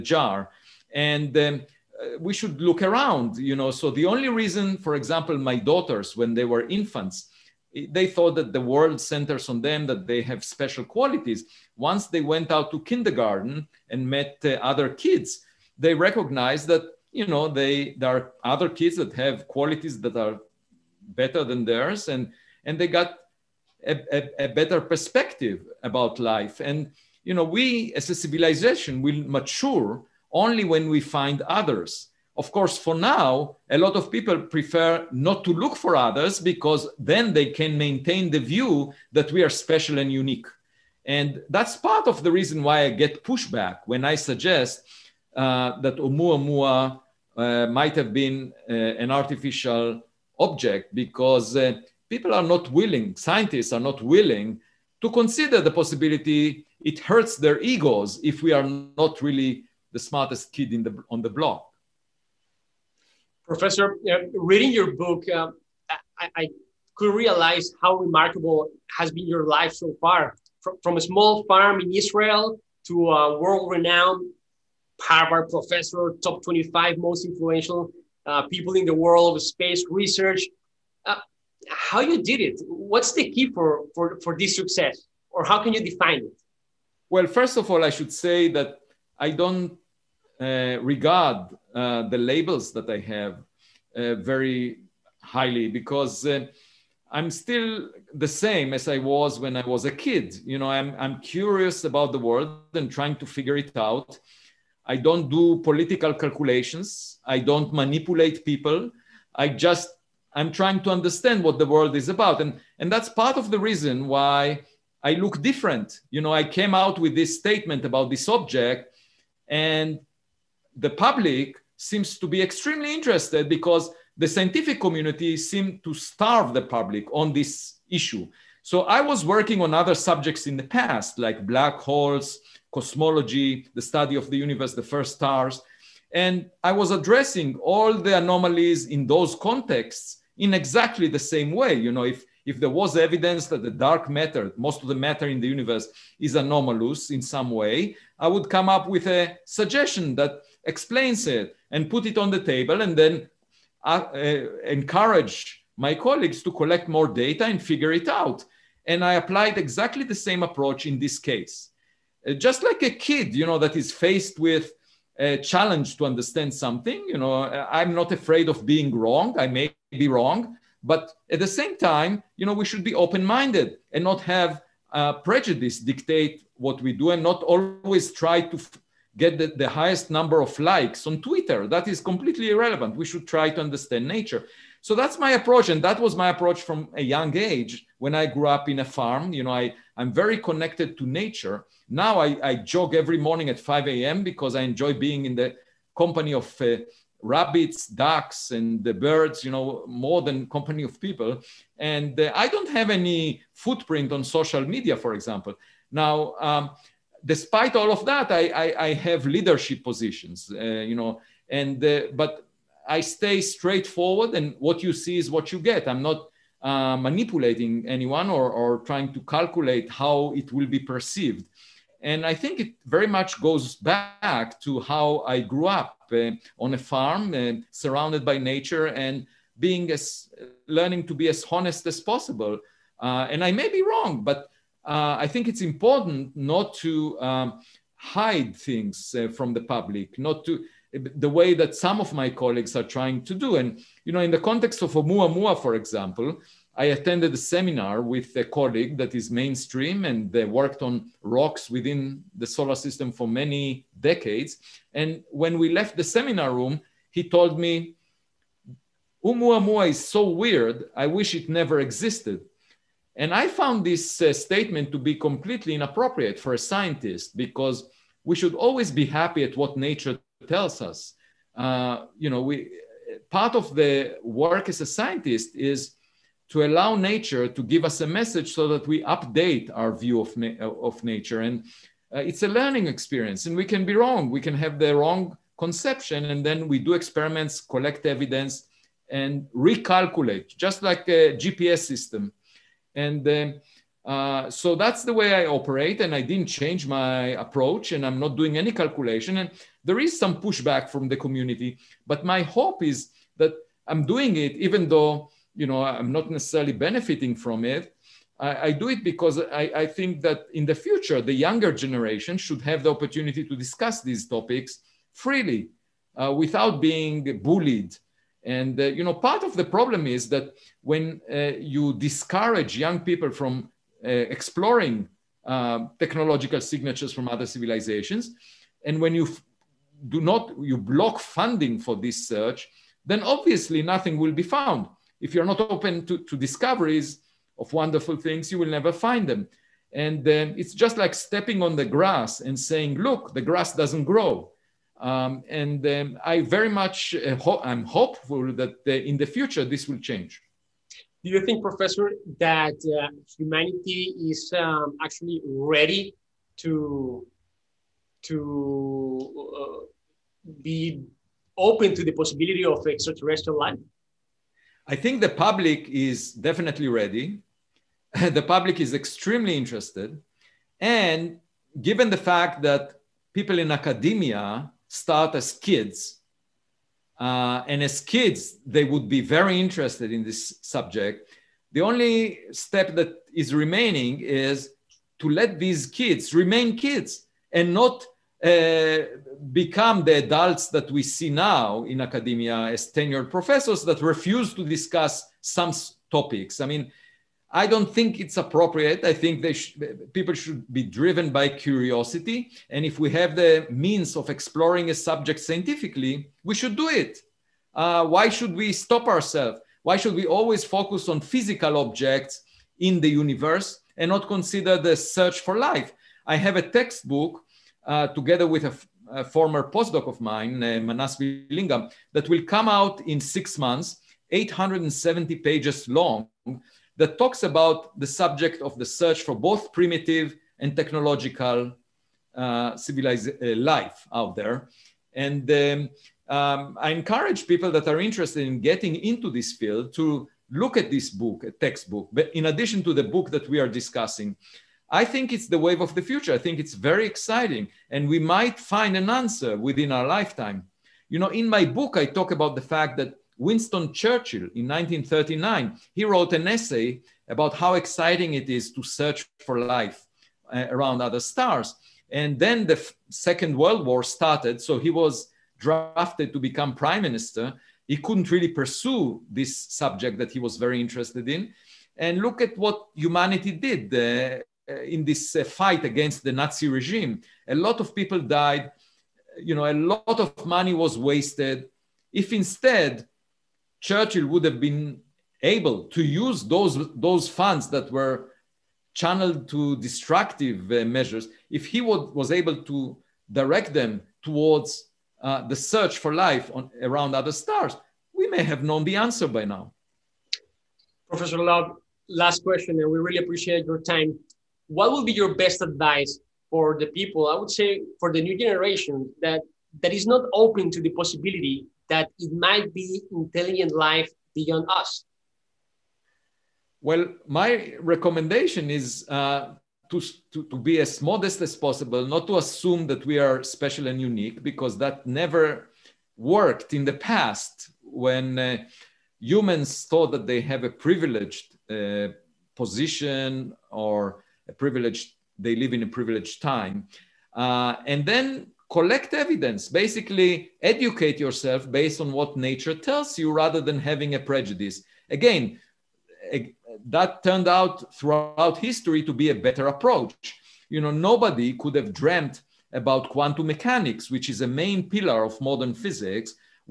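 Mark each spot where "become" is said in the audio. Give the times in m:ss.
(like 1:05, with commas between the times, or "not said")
6:29, 7:46.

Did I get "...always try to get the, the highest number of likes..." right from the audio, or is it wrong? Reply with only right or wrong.
right.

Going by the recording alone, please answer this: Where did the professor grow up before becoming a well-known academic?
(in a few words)
a small farm in Israel.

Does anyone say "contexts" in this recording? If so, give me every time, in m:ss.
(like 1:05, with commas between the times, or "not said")
2:19, 4:04.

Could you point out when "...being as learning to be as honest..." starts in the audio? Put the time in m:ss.
3:49.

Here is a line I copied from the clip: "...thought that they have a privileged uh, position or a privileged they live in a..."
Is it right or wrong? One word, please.
right.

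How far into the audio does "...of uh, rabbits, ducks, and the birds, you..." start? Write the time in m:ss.
3:16.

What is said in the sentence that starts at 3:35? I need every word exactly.
I'm not uh, manipulating anyone or, or trying to calculate how it will be perceived.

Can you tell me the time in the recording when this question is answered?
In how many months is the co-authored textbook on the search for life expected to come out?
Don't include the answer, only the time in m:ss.
7:03.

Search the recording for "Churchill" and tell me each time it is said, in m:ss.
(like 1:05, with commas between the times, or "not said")
7:33, 8:03.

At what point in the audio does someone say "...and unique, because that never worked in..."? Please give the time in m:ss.
8:43.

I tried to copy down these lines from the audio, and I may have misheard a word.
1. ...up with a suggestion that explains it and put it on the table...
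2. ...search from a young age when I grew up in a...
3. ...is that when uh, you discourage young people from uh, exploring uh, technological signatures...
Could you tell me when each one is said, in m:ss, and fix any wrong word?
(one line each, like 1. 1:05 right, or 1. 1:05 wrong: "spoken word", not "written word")
1. 2:28 right
2. 3:06 wrong: "approach", not "search"
3. 5:20 right.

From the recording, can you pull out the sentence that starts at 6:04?
I think the public is definitely ready.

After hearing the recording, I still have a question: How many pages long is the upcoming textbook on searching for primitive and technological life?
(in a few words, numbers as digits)
870.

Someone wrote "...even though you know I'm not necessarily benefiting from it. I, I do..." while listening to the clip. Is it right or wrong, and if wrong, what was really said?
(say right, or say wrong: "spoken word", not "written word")
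right.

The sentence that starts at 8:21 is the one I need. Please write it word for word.
Professor Loeb, last question, and we really appreciate your time.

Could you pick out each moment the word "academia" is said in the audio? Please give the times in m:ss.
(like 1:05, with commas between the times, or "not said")
6:13, 6:32.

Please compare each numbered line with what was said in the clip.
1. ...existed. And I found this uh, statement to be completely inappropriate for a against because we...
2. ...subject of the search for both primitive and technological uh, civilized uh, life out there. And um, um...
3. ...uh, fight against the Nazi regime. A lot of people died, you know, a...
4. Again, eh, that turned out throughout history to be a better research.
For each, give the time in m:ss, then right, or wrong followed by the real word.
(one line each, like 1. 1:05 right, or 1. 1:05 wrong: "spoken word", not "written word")
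1. 4:21 wrong: "scientist", not "against"
2. 7:08 right
3. 7:55 right
4. 9:05 wrong: "approach", not "research".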